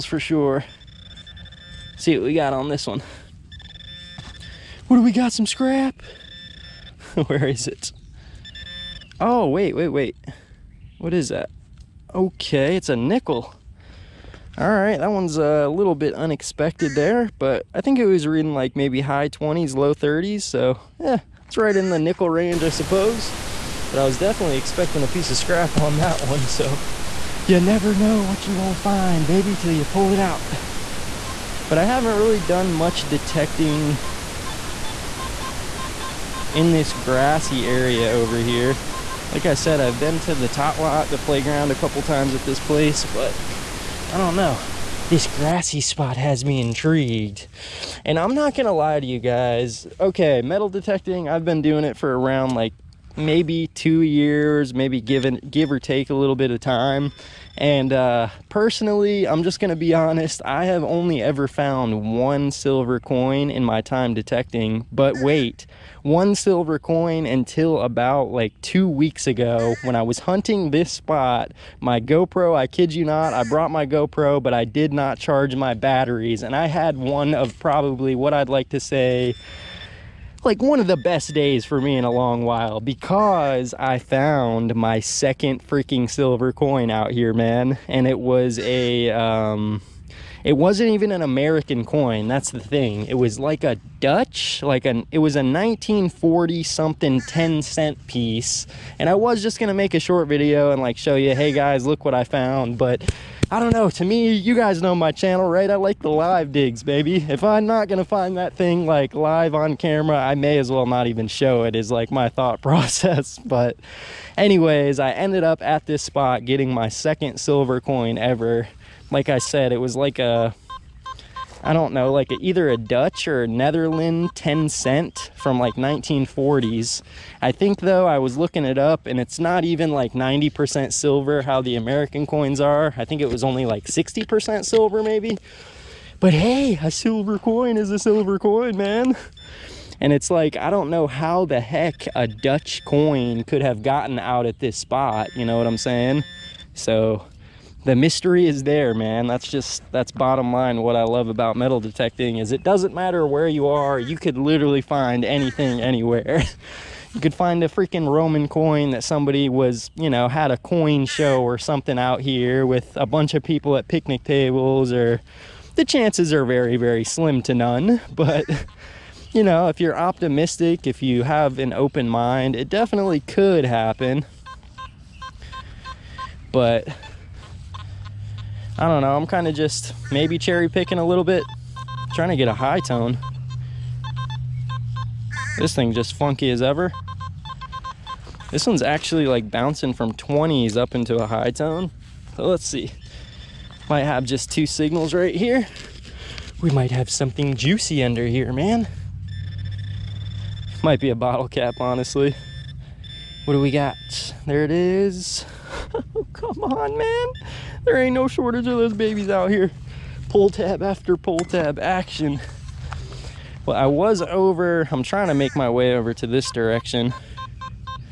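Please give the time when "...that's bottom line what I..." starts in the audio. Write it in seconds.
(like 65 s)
149 s.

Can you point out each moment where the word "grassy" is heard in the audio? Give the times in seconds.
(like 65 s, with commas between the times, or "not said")
36 s, 45 s.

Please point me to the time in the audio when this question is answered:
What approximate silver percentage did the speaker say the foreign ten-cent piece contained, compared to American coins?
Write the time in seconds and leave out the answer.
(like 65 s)
133 s.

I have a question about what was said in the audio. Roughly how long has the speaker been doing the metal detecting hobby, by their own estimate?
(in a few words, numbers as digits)
2 years.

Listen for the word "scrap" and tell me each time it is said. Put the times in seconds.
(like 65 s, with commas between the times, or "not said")
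5 s, 25 s.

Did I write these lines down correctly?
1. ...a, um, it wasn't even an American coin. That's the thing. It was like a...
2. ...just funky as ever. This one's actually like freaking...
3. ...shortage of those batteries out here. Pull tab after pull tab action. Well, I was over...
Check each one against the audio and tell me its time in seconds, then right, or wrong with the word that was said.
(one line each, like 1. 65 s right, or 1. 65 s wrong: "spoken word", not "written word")
1. 88 s right
2. 185 s wrong: "bouncing", not "freaking"
3. 208 s wrong: "babies", not "batteries".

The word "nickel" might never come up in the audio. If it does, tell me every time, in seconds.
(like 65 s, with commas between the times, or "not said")
12 s, 21 s.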